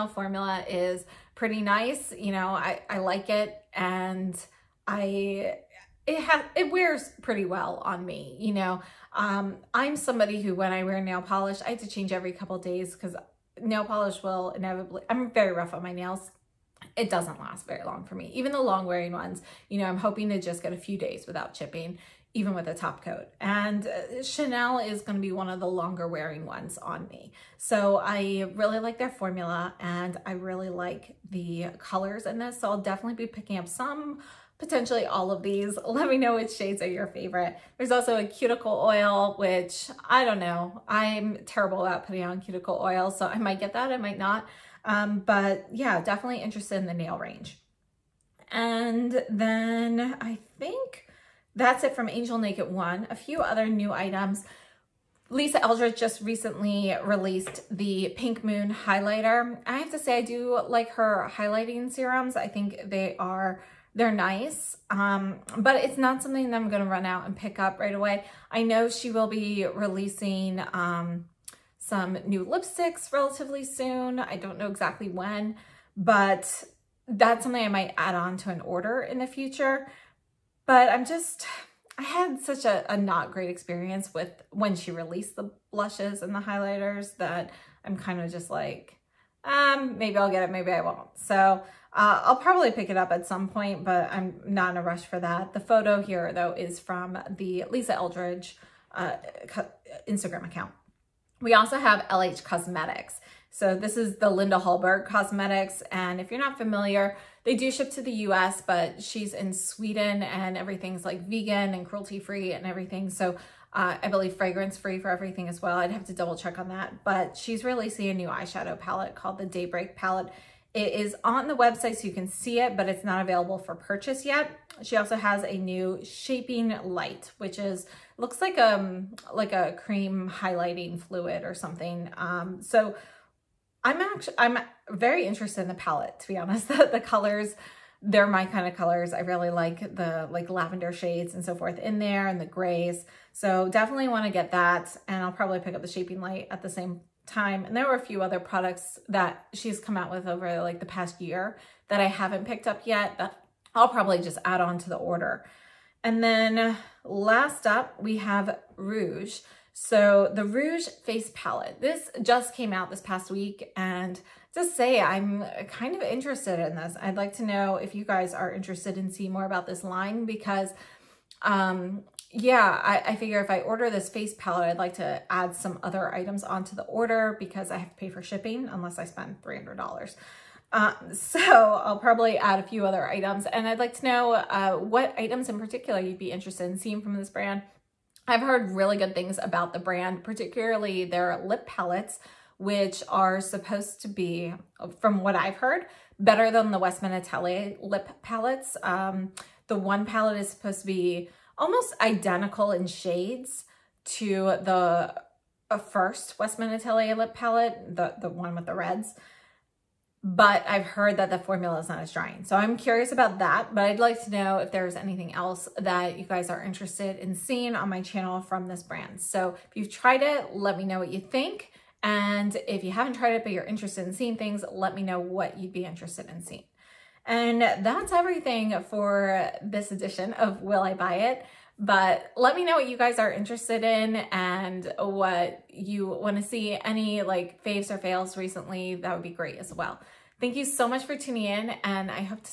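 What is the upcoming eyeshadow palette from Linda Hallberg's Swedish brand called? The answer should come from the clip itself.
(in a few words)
Daybreak.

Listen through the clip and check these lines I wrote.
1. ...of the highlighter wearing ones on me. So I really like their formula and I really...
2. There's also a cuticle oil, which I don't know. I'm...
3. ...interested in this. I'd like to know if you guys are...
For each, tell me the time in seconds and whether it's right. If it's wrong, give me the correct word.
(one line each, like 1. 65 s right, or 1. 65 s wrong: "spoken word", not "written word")
1. 25 s wrong: "longer", not "highlighter"
2. 37 s right
3. 166 s right.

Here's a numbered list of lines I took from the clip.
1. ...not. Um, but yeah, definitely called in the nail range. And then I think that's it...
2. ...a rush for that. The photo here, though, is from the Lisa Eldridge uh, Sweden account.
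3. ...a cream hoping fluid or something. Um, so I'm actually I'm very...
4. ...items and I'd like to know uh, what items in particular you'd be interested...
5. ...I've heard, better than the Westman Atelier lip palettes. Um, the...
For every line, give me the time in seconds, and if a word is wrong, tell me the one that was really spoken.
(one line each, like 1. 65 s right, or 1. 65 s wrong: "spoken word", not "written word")
1. 44 s wrong: "interested", not "called"
2. 94 s wrong: "Instagram", not "Sweden"
3. 129 s wrong: "highlighting", not "hoping"
4. 183 s right
5. 195 s right.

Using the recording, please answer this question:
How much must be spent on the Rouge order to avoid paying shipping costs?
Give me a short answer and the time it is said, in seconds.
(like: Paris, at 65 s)
$300, at 179 s.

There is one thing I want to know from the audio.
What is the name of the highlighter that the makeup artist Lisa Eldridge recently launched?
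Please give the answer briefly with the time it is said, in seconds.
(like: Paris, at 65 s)
Pink Moon, at 58 s.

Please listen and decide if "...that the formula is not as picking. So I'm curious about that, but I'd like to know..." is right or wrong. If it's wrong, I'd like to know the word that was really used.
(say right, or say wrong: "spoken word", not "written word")
wrong: "drying", not "picking".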